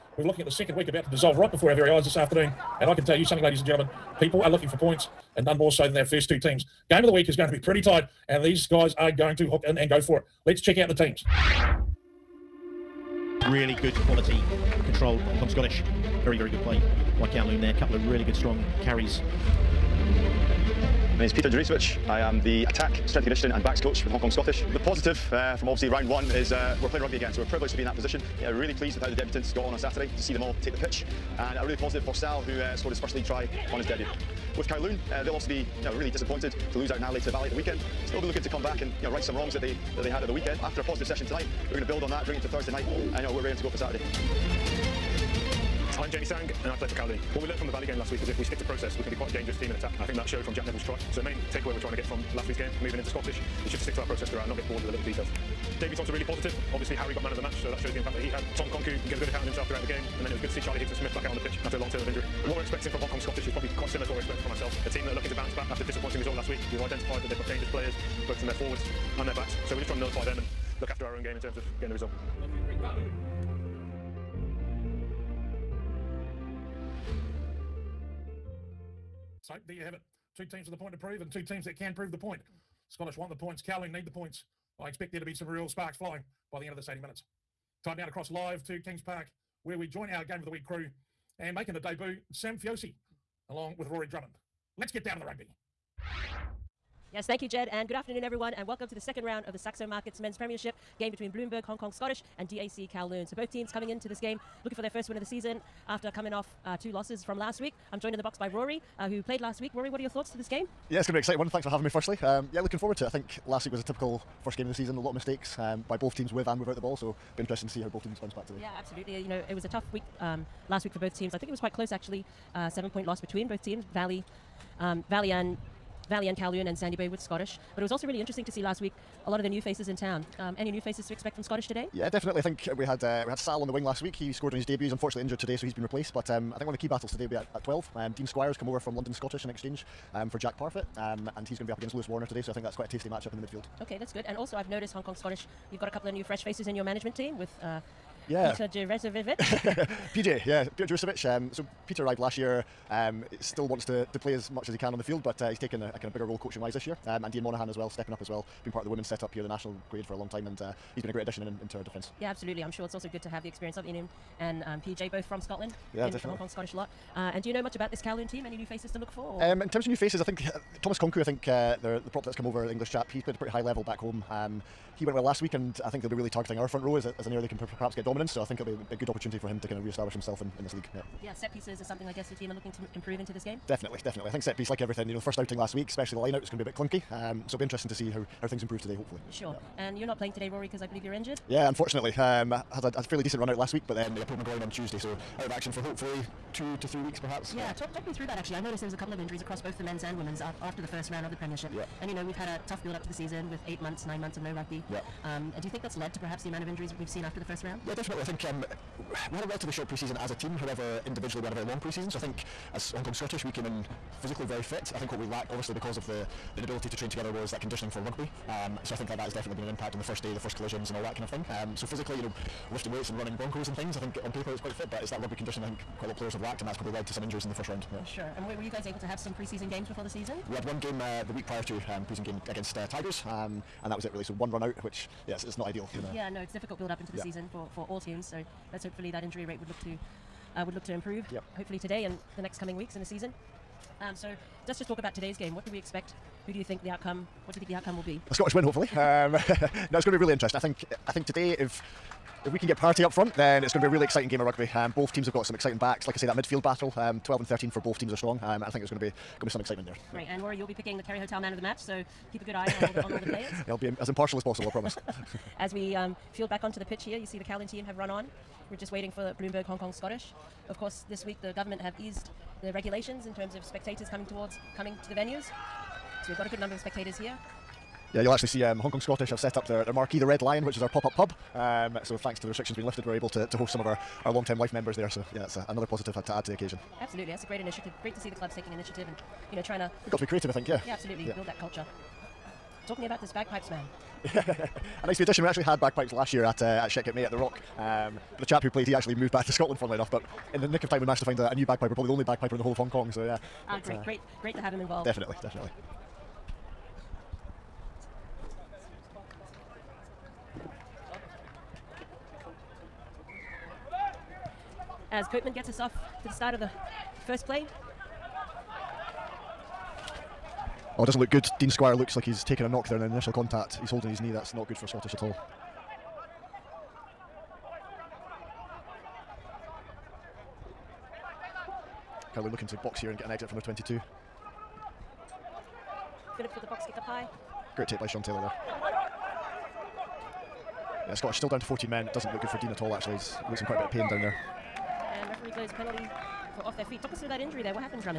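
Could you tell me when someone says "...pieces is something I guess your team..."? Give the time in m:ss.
3:01.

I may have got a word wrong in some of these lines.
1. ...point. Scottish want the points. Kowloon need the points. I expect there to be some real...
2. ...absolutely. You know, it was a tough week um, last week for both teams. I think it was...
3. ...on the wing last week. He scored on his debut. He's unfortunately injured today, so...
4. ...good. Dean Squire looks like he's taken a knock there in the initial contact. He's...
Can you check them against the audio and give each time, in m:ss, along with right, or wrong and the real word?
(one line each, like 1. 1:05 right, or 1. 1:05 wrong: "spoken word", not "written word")
1. 1:22 right
2. 1:58 right
3. 2:13 right
4. 5:21 right.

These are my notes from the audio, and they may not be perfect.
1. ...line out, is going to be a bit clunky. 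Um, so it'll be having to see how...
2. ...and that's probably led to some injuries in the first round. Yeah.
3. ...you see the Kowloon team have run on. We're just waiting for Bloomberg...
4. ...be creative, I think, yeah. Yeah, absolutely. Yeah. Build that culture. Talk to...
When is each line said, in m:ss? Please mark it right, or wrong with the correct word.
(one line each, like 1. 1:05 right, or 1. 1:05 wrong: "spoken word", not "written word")
1. 3:06 wrong: "interesting", not "having"
2. 3:46 right
3. 4:27 right
4. 4:50 right.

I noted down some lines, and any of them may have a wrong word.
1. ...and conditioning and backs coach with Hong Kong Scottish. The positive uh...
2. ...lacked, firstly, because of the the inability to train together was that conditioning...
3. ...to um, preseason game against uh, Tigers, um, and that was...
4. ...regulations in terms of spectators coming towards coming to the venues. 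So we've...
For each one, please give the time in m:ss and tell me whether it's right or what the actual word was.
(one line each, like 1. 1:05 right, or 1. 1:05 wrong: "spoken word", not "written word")
1. 0:23 right
2. 3:35 wrong: "obviously", not "firstly"
3. 3:51 right
4. 4:32 right.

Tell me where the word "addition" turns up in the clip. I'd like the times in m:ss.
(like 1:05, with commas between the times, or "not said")
2:41, 4:55.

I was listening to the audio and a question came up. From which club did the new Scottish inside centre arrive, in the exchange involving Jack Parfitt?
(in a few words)
London Scottish.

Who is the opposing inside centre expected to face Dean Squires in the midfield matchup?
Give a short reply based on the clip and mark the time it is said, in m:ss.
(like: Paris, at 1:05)
Lewis Warner, at 2:21.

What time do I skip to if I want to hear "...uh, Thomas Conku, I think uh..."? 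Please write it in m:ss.
2:50.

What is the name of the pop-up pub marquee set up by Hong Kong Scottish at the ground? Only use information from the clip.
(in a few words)
Red Lion.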